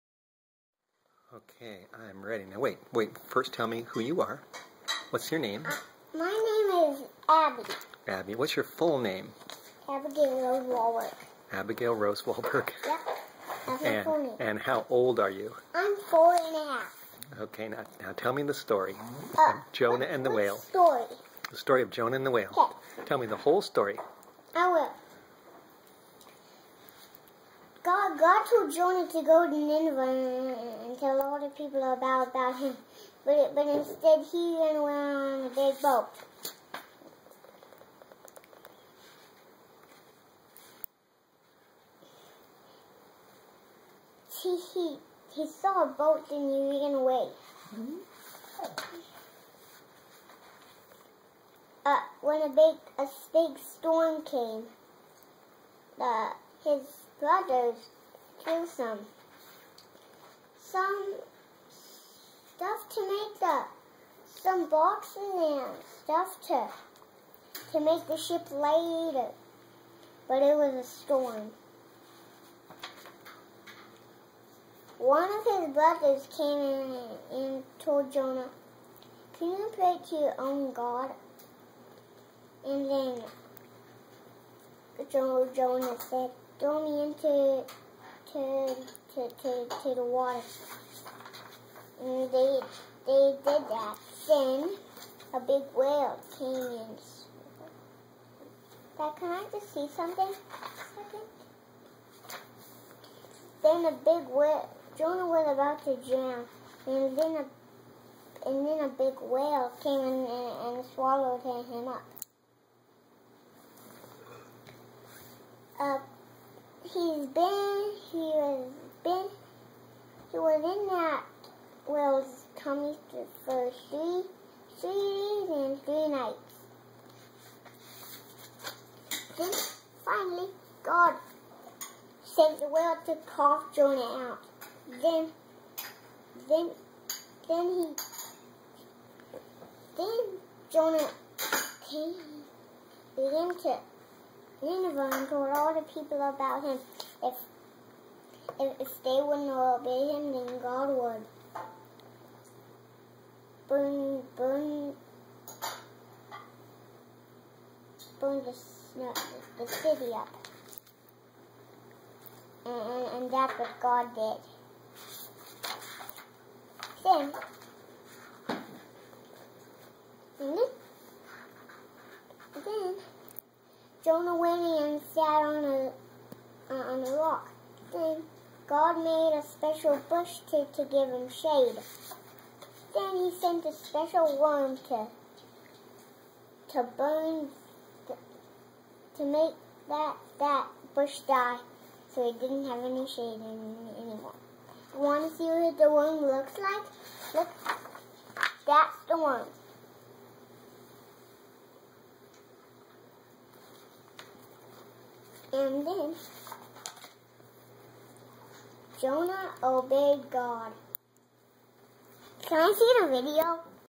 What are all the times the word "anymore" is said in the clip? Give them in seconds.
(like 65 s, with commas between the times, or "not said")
194 s.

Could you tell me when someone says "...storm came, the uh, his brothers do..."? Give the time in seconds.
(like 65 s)
53 s.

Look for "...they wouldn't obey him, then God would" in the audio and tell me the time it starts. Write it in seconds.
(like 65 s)
149 s.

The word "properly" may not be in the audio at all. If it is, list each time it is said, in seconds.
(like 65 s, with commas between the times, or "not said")
not said.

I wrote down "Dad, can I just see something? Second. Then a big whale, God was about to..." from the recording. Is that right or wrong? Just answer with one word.
wrong.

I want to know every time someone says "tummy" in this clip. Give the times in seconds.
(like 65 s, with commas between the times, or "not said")
122 s.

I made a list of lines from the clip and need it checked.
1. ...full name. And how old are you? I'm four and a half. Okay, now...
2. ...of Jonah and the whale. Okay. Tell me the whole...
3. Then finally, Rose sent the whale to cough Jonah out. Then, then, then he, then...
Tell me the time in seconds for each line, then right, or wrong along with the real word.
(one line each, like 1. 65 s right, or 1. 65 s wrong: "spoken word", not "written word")
1. 14 s right
2. 21 s right
3. 129 s wrong: "God", not "Rose".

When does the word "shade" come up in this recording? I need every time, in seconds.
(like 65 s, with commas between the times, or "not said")
181 s, 193 s.